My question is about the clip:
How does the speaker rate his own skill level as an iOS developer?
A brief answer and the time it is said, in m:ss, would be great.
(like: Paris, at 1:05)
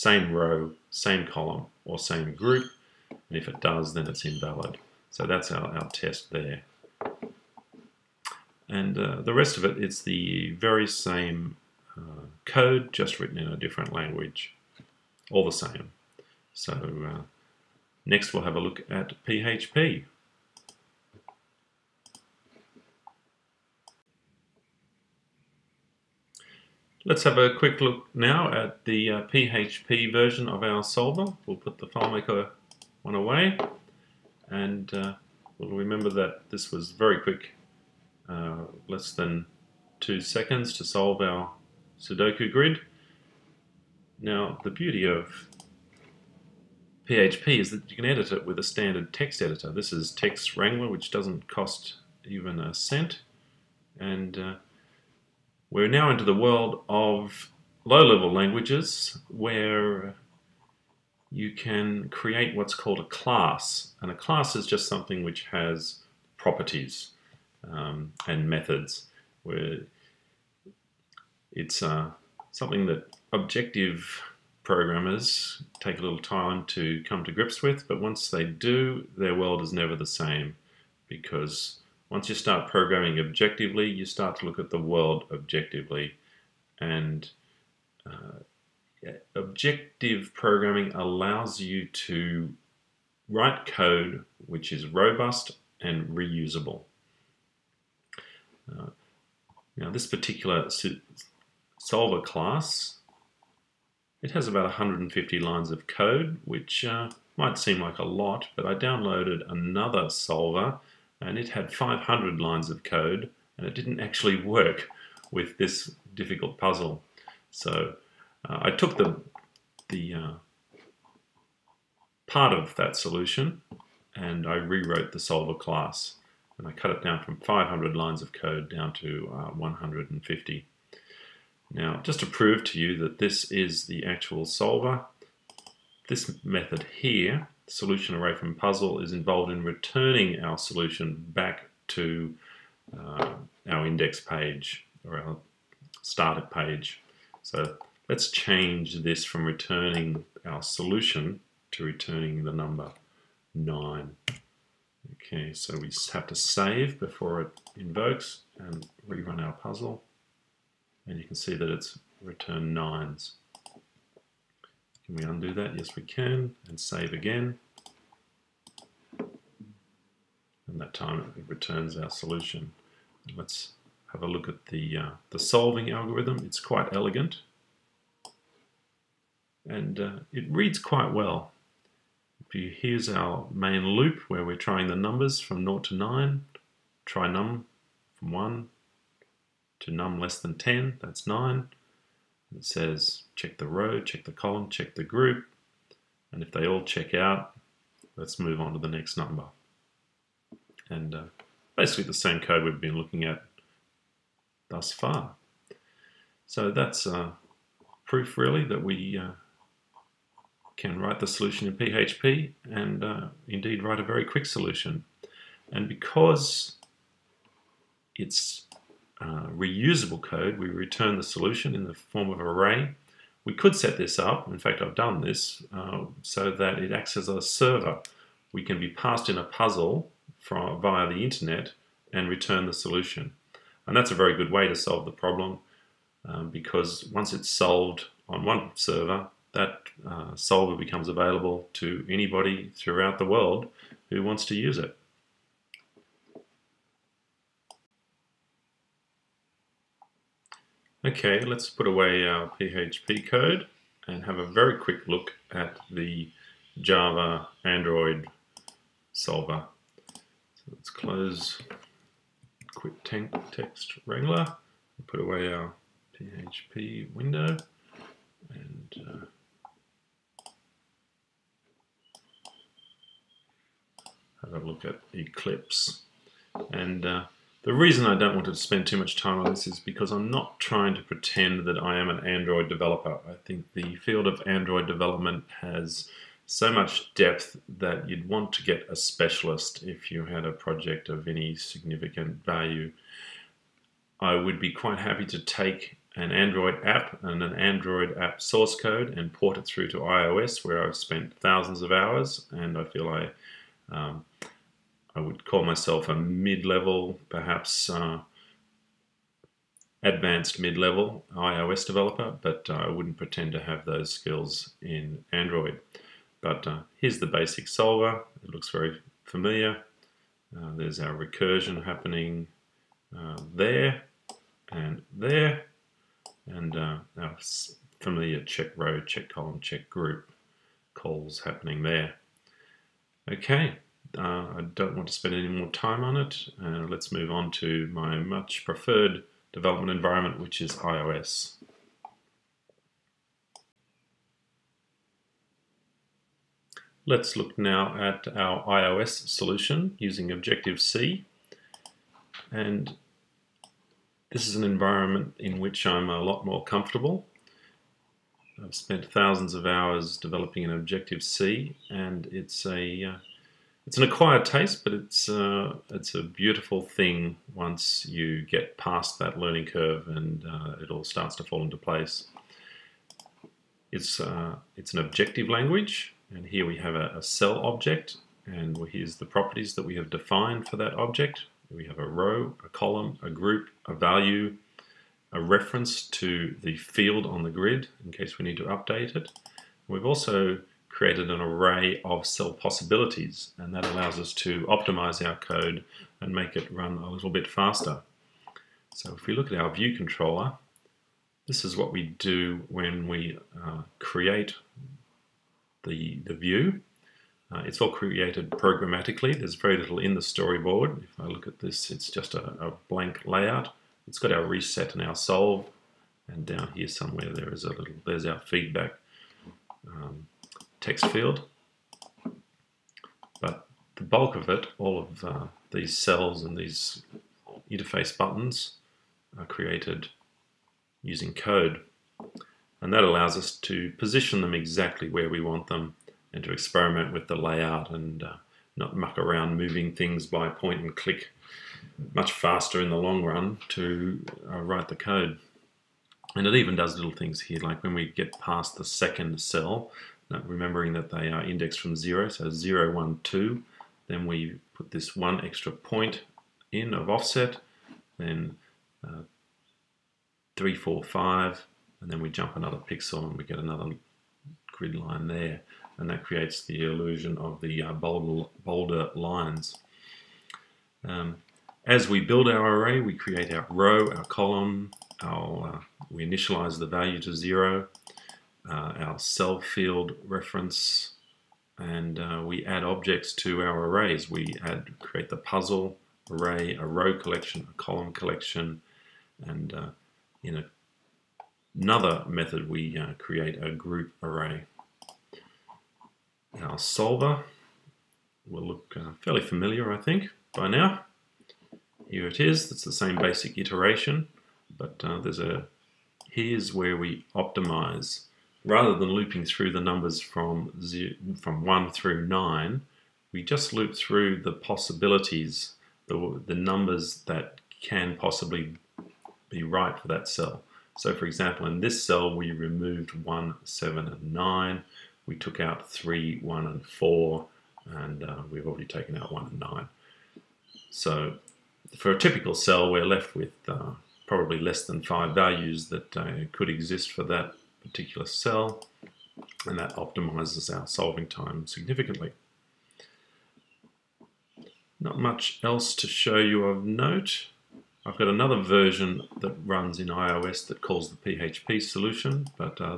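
advanced mid-level, at 5:10.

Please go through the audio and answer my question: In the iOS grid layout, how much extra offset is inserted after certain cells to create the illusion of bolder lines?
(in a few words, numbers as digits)
1 point.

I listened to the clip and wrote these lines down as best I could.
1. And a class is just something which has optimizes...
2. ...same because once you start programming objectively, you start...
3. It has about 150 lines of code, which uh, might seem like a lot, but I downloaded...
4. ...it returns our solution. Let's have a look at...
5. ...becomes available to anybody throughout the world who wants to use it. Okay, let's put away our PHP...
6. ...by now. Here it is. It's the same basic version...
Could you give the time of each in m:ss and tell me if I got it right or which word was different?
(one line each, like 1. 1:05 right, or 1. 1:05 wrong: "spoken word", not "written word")
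1. 1:04 wrong: "properties", not "optimizes"
2. 1:20 right
3. 1:44 right
4. 2:51 right
5. 4:00 right
6. 8:20 wrong: "iteration", not "version".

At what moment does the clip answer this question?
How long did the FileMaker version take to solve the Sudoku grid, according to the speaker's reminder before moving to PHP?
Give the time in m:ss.
0:38.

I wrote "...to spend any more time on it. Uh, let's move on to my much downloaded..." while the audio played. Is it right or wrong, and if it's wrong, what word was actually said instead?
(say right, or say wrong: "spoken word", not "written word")
wrong: "preferred", not "downloaded".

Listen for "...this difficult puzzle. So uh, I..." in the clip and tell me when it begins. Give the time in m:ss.
1:55.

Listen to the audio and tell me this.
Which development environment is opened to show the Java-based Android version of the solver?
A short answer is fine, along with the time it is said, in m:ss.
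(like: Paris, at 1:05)
Eclipse, at 4:35.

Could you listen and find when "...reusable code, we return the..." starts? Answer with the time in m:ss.
3:39.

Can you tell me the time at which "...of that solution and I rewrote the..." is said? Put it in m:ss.
2:02.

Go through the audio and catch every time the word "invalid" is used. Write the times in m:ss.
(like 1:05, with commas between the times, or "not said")
0:04.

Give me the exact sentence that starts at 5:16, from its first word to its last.
But uh, here's the basic solver.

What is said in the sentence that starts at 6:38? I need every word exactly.
So if we look at our view controller, this is what we do when we uh, create the, the view.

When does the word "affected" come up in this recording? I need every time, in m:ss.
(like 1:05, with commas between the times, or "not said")
not said.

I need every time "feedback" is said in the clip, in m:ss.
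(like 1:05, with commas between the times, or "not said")
6:58.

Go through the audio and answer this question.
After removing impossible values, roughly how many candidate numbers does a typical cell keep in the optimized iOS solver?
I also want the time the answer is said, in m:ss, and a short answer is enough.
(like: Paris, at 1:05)
less than 5, at 8:54.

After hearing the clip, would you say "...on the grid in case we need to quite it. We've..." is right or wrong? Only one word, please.
wrong.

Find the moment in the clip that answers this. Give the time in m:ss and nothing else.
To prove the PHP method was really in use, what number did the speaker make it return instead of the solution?
2:32.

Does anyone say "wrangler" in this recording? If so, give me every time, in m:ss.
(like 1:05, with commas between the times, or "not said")
0:50, 4:24.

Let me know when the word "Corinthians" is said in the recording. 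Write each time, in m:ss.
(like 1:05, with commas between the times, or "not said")
not said.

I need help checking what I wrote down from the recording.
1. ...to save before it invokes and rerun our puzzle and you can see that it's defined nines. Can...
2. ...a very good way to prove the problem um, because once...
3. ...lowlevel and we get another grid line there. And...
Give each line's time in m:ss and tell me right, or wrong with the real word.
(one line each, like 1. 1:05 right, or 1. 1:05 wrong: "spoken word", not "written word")
1. 2:36 wrong: "returned", not "defined"
2. 3:54 wrong: "solve", not "prove"
3. 7:42 wrong: "pixel", not "lowlevel".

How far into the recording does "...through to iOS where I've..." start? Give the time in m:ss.
4:59.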